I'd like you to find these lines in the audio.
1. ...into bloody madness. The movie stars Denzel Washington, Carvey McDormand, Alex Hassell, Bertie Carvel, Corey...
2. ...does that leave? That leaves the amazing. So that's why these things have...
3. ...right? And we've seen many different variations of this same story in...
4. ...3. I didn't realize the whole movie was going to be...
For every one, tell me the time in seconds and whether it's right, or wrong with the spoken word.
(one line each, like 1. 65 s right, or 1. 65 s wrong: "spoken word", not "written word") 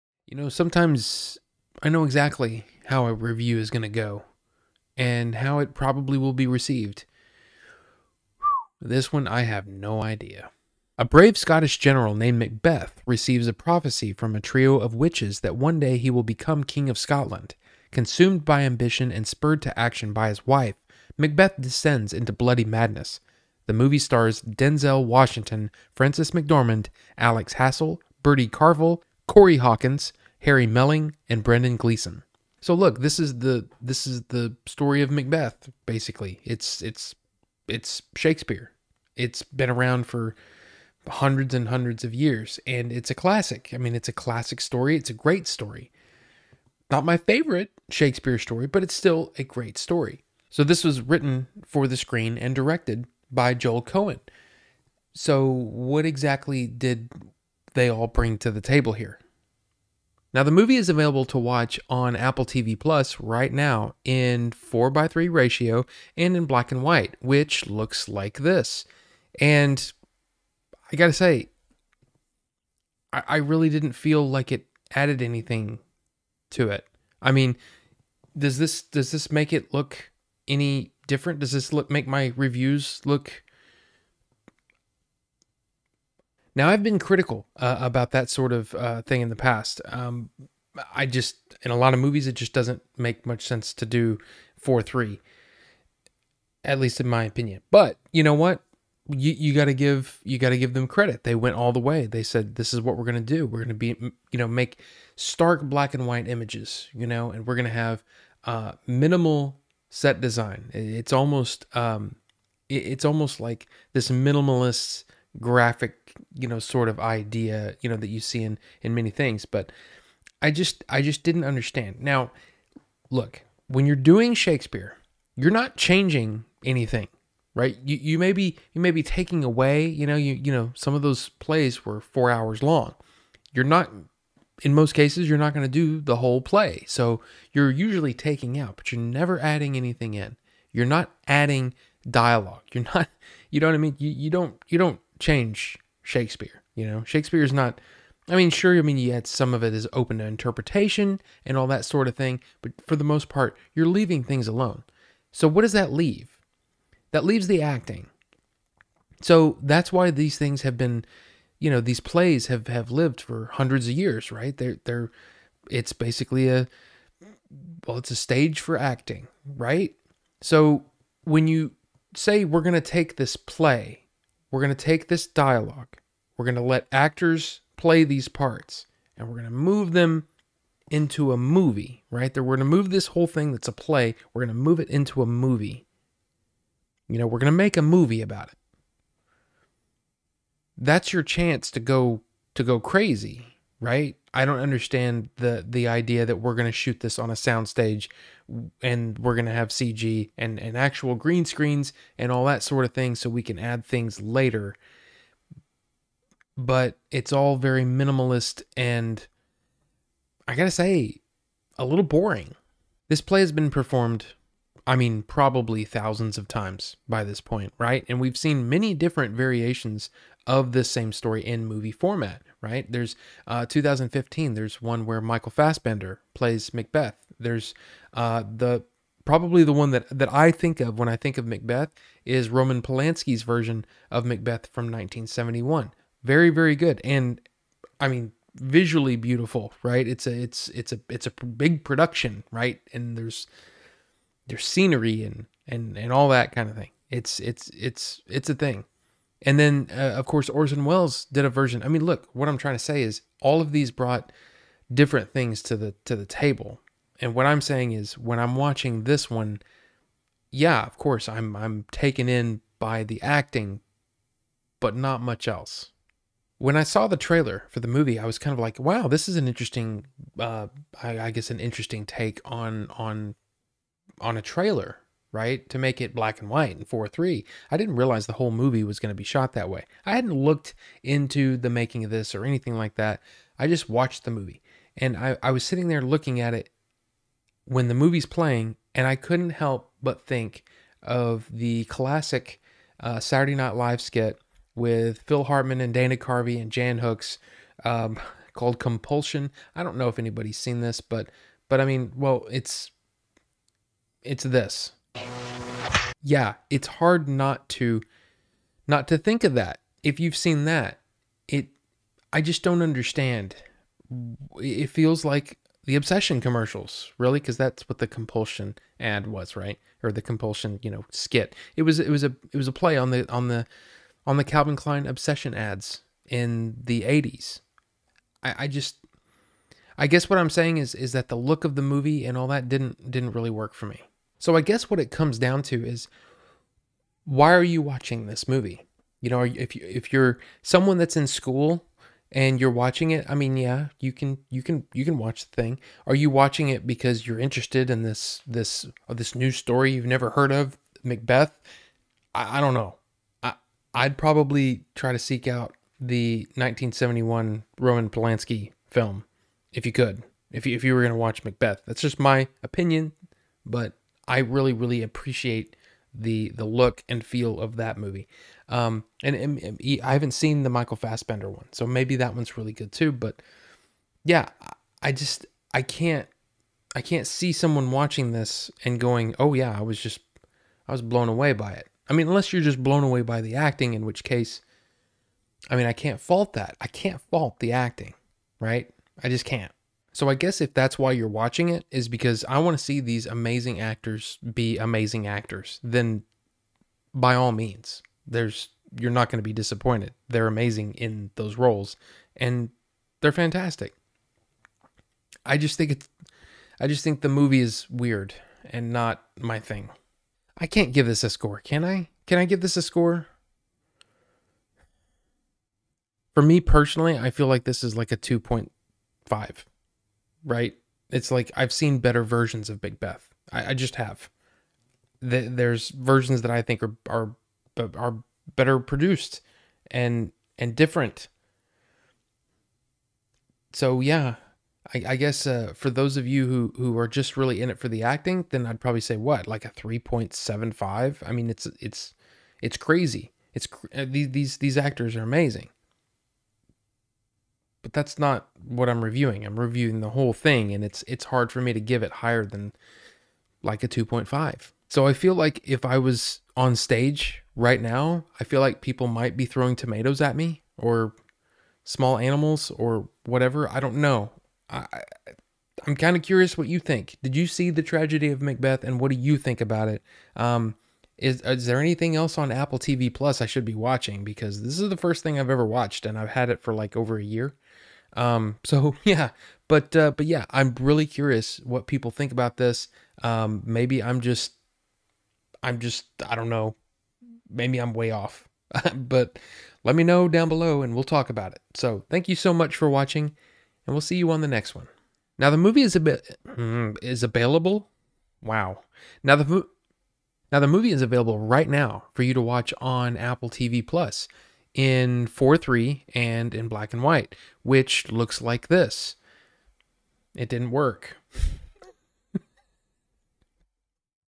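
1. 22 s wrong: "Frances", not "Carvey"
2. 155 s wrong: "acting", not "amazing"
3. 217 s right
4. 277 s right.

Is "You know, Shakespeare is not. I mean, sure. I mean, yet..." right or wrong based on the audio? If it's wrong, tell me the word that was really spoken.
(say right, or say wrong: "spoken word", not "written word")
right.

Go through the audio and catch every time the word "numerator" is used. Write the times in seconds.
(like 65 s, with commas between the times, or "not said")
not said.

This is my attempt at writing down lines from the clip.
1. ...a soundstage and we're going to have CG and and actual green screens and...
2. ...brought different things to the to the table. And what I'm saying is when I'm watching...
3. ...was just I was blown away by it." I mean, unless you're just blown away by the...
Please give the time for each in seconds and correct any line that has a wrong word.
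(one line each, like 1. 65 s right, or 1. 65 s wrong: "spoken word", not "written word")
1. 197 s right
2. 253 s right
3. 379 s right.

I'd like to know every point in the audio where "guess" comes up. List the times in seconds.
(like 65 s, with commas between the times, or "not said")
271 s, 330 s, 334 s, 390 s, 435 s.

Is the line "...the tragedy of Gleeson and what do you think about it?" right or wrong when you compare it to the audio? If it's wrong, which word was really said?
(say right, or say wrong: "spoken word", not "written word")
wrong: "Macbeth", not "Gleeson".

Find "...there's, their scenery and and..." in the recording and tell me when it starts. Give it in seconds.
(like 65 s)
243 s.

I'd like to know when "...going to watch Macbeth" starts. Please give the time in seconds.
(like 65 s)
361 s.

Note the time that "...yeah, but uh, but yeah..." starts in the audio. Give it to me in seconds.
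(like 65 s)
479 s.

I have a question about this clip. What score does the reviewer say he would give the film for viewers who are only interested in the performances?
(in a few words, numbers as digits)
3.75.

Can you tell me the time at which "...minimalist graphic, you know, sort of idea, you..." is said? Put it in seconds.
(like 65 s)
114 s.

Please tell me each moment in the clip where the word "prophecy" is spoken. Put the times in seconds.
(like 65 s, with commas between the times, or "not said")
13 s.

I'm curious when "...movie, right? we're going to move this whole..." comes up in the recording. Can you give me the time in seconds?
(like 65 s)
181 s.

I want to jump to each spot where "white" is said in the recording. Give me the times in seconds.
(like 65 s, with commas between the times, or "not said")
66 s, 106 s, 276 s, 507 s.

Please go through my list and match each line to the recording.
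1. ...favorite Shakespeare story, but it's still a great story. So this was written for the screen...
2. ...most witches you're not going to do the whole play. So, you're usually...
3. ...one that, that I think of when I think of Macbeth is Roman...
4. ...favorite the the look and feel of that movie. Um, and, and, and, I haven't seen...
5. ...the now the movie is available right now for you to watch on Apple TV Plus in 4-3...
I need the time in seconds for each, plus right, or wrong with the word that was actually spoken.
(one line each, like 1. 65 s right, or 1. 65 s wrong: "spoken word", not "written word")
1. 47 s right
2. 134 s wrong: "cases", not "witches"
3. 229 s right
4. 365 s wrong: "appreciate", not "favorite"
5. 499 s right.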